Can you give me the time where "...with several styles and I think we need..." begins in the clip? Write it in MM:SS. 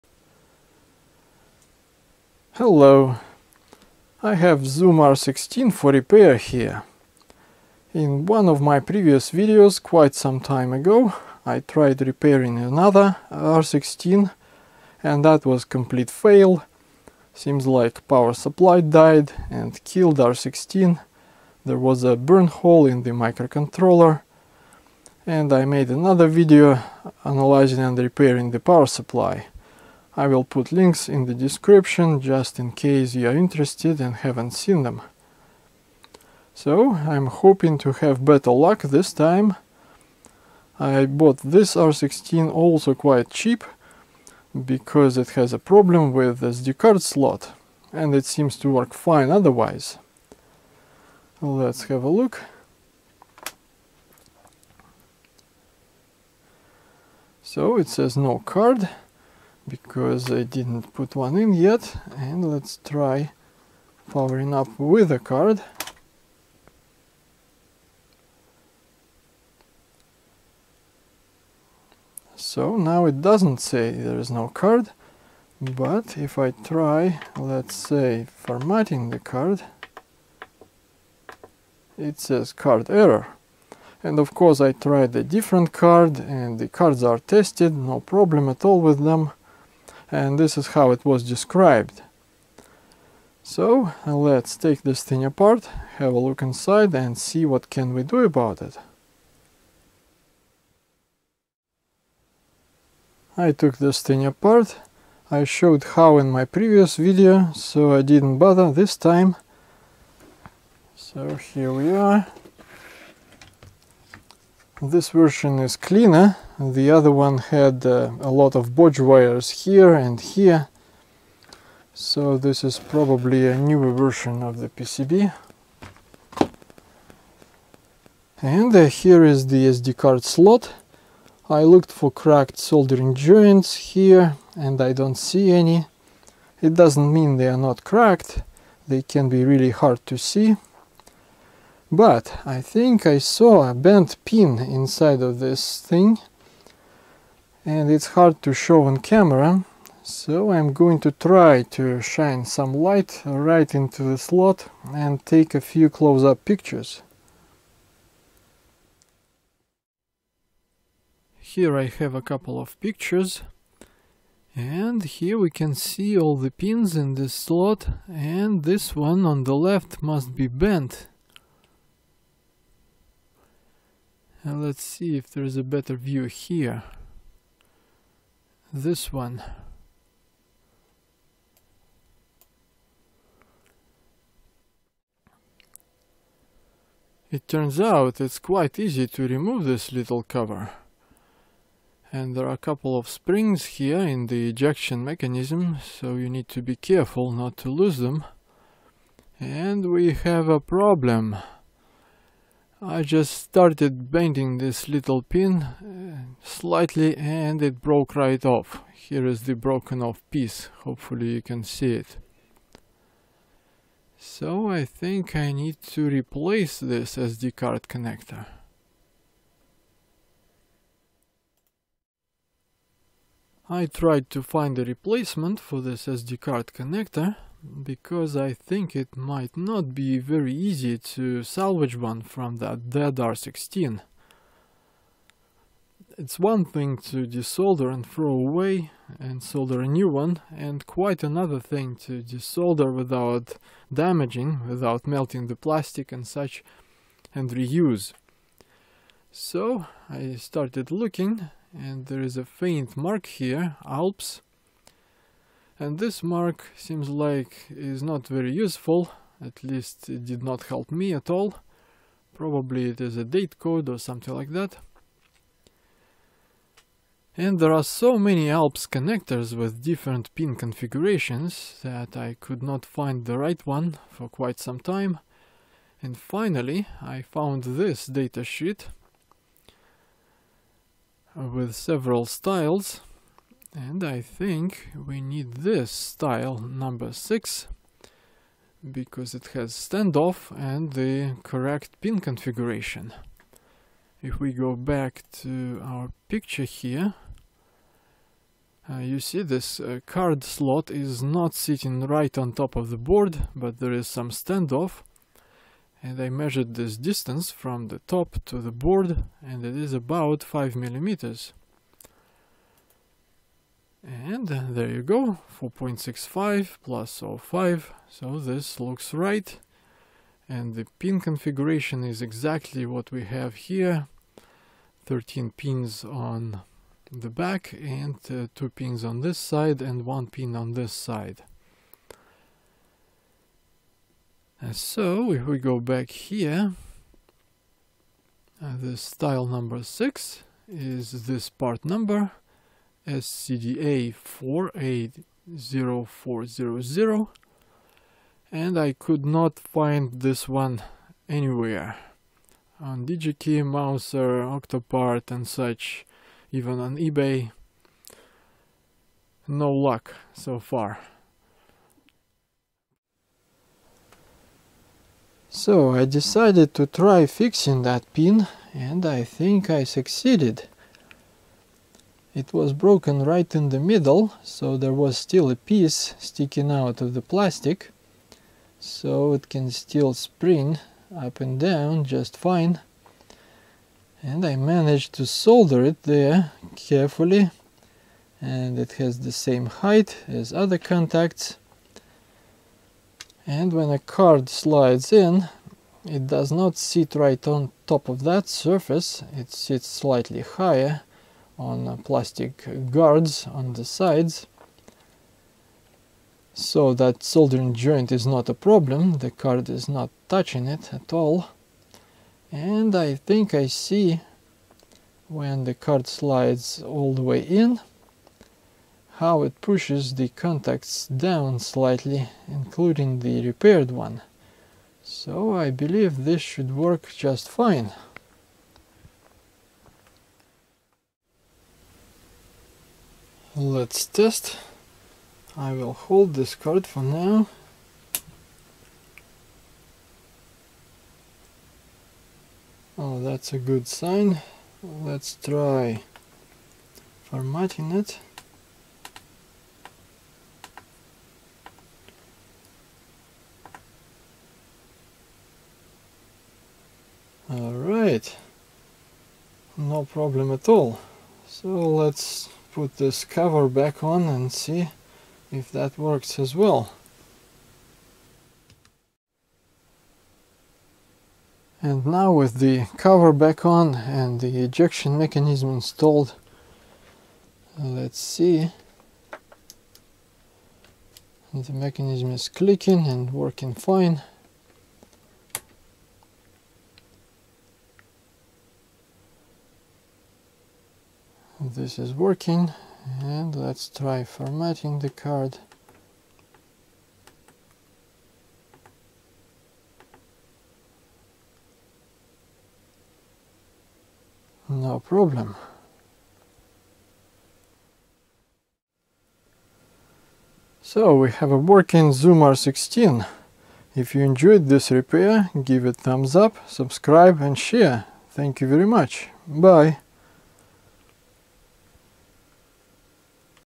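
04:41.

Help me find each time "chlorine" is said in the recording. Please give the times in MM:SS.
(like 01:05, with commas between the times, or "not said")
not said.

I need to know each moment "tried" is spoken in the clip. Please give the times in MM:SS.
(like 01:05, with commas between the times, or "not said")
00:11, 01:24, 03:43.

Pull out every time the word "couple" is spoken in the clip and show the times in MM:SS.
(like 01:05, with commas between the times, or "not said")
02:42, 03:12.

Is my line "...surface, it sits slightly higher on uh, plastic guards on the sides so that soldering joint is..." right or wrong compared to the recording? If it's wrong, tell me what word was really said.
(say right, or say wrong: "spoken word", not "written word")
right.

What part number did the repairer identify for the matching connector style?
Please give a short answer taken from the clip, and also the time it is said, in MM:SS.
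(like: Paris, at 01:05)
SCDA 480400, at 05:43.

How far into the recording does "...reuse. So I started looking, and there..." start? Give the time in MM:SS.
04:07.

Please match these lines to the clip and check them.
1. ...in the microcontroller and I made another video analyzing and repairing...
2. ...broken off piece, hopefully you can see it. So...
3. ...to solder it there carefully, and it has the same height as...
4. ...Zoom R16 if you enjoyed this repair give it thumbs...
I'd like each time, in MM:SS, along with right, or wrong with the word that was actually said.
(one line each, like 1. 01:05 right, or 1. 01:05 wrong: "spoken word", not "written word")
1. 00:22 right
2. 03:29 right
3. 06:25 right
4. 08:32 right.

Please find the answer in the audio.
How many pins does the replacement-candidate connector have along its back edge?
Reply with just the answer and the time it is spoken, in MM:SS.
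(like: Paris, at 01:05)
13, at 05:25.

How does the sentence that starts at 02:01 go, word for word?
So this is probably a newer version of the PCB.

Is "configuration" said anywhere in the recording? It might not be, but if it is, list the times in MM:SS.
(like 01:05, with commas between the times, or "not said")
04:30, 04:52, 05:21.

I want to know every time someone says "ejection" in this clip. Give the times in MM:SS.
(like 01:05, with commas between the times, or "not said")
03:14, 07:54.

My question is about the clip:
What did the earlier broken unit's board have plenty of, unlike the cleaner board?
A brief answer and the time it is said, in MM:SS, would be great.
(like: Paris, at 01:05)
bodge wires, at 01:58.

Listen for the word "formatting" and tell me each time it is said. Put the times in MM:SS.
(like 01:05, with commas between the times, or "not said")
01:18, 07:27, 08:14.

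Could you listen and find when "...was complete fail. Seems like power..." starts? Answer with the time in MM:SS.
00:15.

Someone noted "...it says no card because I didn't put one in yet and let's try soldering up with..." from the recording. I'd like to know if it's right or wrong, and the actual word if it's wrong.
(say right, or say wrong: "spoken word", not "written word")
wrong: "powering", not "soldering".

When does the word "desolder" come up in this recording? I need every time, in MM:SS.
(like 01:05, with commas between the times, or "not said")
03:57, 04:02.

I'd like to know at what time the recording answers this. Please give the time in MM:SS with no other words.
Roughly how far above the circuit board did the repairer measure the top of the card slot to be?
05:10.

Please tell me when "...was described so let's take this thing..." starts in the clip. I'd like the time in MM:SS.
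01:31.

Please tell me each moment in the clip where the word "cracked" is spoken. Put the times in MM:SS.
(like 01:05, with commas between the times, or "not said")
02:12, 02:17.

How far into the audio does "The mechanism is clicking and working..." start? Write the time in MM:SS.
08:01.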